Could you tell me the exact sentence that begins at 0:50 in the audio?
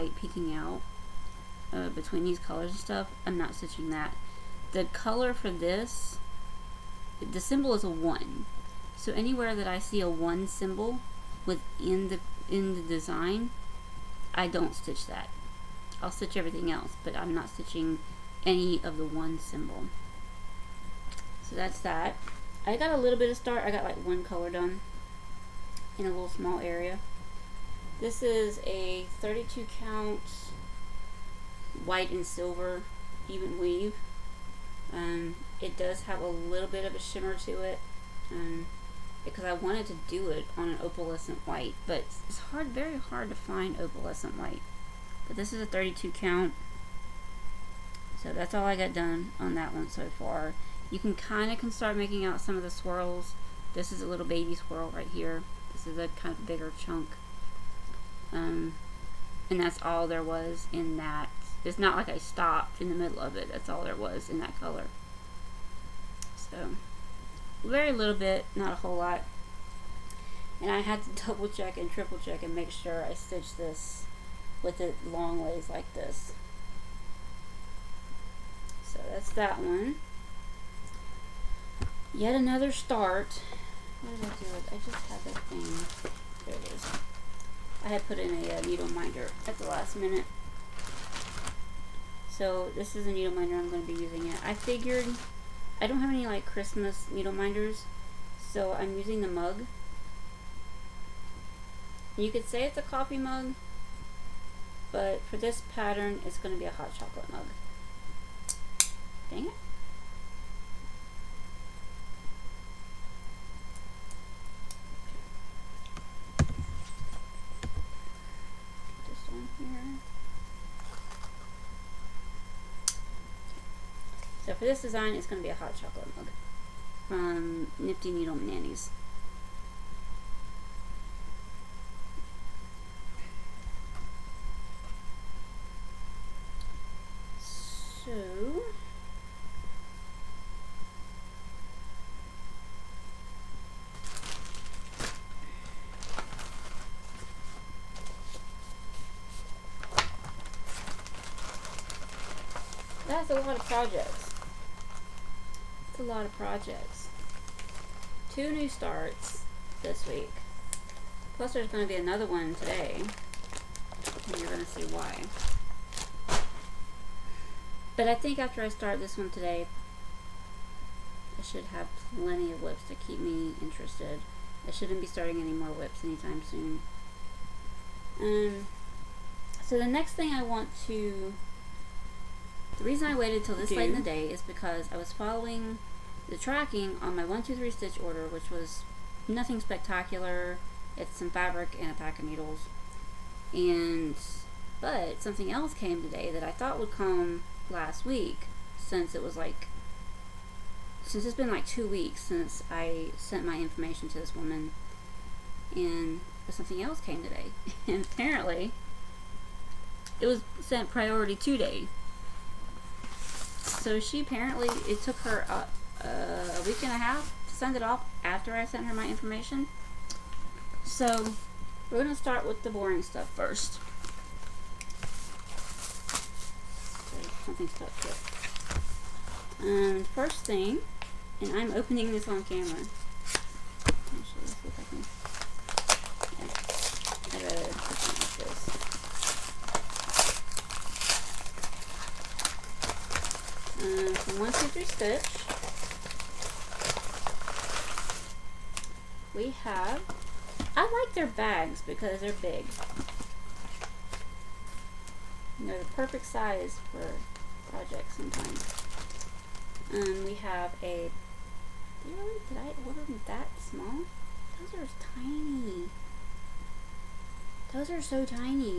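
You can kind of can start making out some of the swirls.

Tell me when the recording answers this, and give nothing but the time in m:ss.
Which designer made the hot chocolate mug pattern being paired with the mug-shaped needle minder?
2:07.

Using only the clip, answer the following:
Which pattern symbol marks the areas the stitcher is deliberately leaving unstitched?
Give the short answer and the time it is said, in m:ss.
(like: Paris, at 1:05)
1, at 0:07.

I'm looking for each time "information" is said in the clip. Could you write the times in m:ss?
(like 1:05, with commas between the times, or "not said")
3:23, 3:39.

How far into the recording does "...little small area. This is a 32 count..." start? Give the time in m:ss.
0:26.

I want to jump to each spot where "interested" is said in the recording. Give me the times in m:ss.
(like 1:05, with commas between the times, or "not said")
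2:53.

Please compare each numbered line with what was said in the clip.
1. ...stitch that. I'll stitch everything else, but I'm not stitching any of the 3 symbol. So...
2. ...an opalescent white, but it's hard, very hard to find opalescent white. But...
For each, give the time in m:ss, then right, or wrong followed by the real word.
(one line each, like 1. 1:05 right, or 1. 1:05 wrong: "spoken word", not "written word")
1. 0:14 wrong: "1", not "3"
2. 0:40 right.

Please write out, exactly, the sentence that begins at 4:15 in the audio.
And they're the perfect size for projects sometimes.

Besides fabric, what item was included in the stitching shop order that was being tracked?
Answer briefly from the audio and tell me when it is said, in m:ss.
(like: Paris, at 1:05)
A pack of needles, at 3:11.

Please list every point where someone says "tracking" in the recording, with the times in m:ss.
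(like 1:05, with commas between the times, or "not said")
3:06.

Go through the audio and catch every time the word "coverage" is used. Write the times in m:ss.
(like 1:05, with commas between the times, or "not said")
not said.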